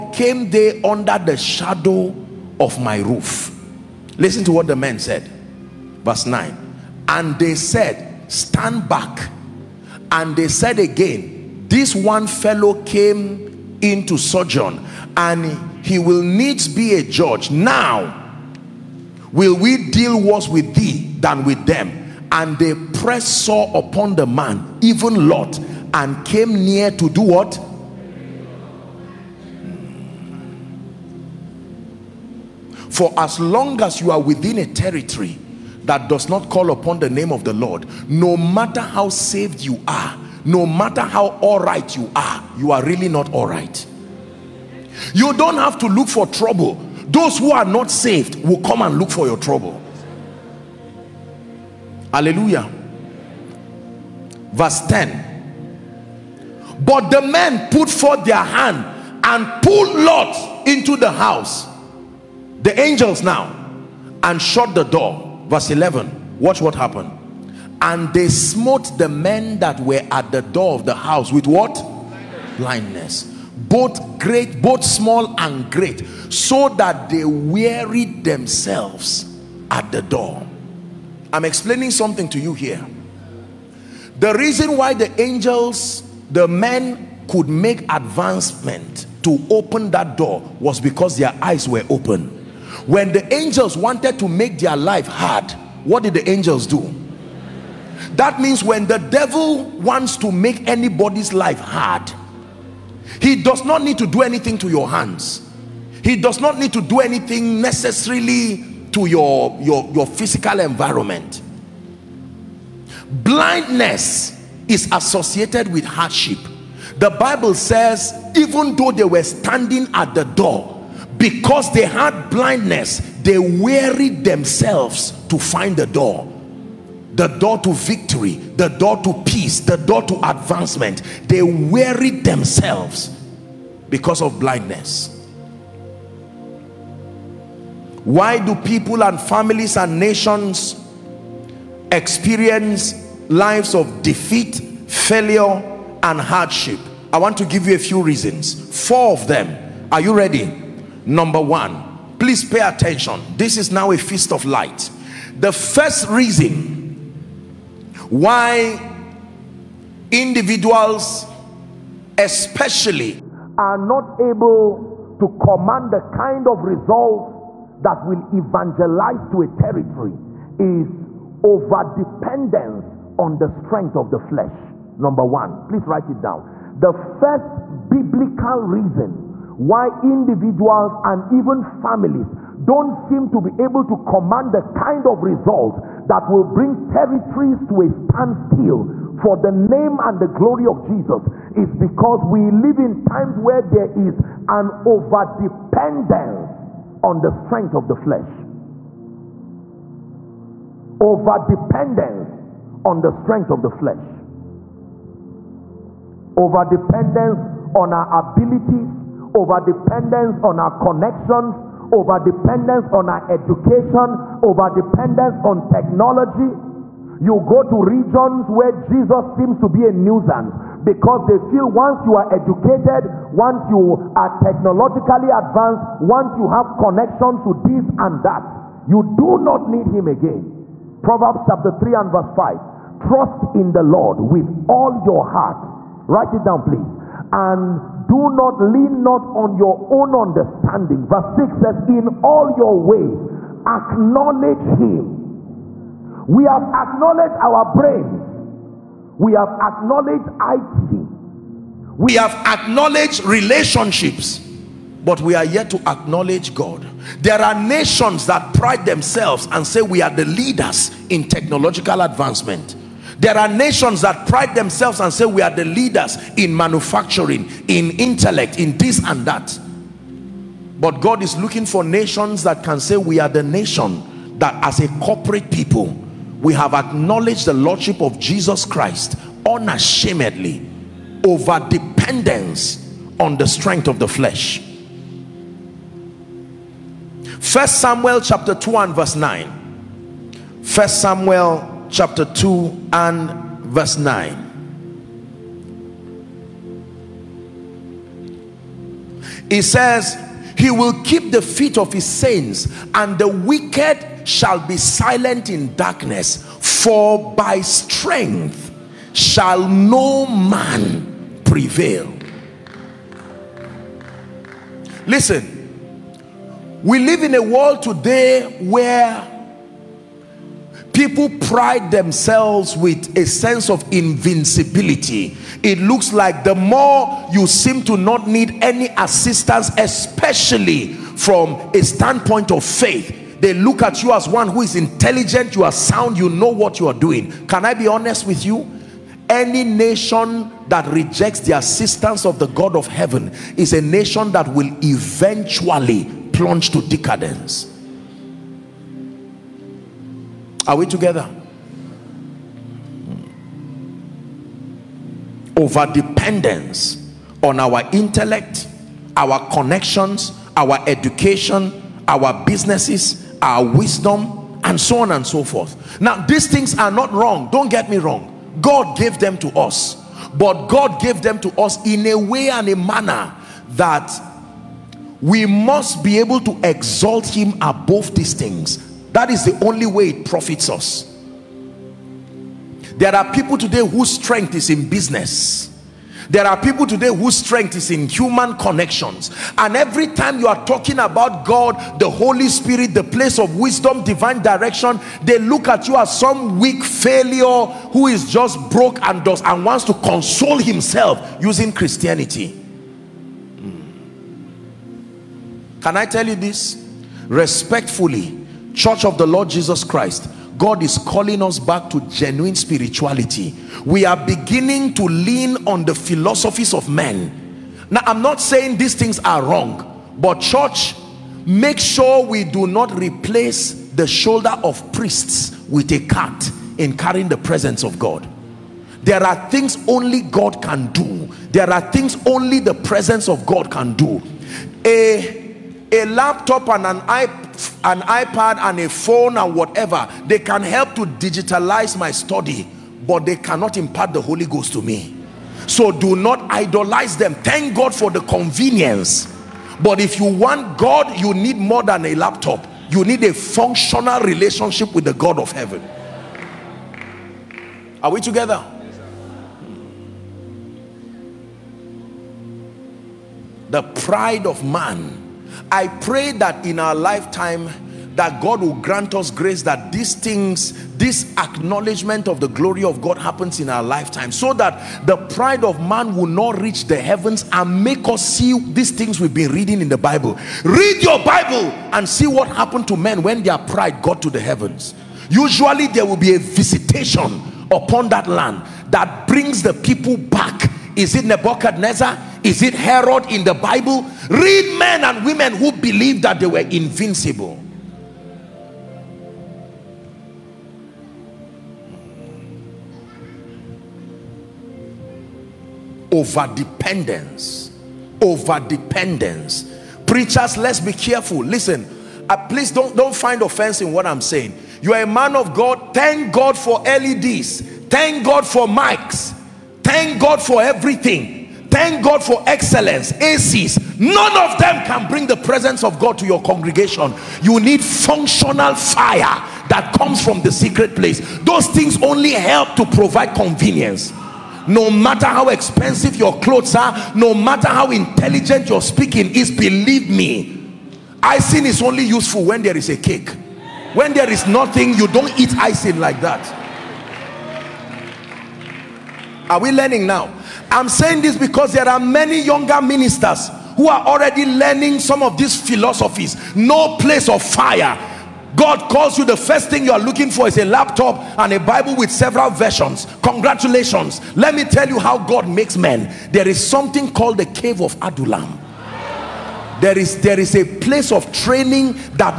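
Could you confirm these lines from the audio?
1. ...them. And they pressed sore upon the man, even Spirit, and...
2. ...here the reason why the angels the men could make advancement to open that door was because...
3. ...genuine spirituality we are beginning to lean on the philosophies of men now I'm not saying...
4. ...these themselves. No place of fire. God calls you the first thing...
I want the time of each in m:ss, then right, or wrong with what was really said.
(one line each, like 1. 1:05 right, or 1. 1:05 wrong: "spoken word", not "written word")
1. 0:21 wrong: "Lot", not "Spirit"
2. 1:22 right
3. 6:52 right
4. 9:15 wrong: "philosophies", not "themselves".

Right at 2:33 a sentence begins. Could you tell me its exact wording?
This is now a feast of light.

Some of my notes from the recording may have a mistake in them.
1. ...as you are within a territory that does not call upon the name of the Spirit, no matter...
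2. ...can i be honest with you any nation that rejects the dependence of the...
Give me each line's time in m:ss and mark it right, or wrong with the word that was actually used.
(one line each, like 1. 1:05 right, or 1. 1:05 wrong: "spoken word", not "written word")
1. 0:33 wrong: "Lord", not "Spirit"
2. 5:37 wrong: "assistance", not "dependence".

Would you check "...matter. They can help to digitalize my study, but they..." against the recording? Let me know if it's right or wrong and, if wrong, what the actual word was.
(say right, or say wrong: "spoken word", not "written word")
wrong: "whatever", not "matter".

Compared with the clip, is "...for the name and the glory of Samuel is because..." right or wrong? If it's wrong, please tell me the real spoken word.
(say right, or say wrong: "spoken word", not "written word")
wrong: "Jesus", not "Samuel".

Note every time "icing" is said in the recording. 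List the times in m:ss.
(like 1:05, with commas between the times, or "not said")
9:01, 9:05.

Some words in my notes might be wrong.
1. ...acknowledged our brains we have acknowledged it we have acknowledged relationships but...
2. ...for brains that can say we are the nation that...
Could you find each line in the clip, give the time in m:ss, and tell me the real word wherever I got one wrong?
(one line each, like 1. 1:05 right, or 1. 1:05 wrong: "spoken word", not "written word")
1. 4:06 right
2. 4:31 wrong: "nations", not "brains".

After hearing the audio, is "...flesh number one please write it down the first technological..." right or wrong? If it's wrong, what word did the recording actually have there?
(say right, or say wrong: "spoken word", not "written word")
wrong: "biblical", not "technological".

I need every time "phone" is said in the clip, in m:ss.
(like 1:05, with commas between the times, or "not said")
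7:18.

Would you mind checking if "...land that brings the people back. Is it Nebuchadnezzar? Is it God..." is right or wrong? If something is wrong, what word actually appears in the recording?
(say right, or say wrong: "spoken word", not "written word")
wrong: "Herod", not "God".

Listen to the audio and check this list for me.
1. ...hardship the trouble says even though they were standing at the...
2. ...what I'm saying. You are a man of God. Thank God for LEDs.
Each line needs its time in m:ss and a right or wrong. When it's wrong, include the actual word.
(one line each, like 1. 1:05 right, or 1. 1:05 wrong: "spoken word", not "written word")
1. 1:55 wrong: "bible", not "trouble"
2. 8:33 right.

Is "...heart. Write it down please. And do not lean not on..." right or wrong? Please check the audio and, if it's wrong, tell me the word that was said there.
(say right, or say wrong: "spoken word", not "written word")
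right.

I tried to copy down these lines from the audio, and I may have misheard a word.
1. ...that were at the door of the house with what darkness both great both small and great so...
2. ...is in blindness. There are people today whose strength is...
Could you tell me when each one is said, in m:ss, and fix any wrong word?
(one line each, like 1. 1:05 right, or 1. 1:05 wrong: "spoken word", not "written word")
1. 1:09 wrong: "blindness", not "darkness"
2. 6:24 wrong: "business", not "blindness".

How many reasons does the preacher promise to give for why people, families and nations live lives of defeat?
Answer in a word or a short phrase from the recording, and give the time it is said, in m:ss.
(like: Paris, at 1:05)
4, at 2:28.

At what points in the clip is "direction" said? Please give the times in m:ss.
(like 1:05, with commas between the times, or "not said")
6:34.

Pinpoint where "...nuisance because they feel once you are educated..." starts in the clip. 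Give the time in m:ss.
3:39.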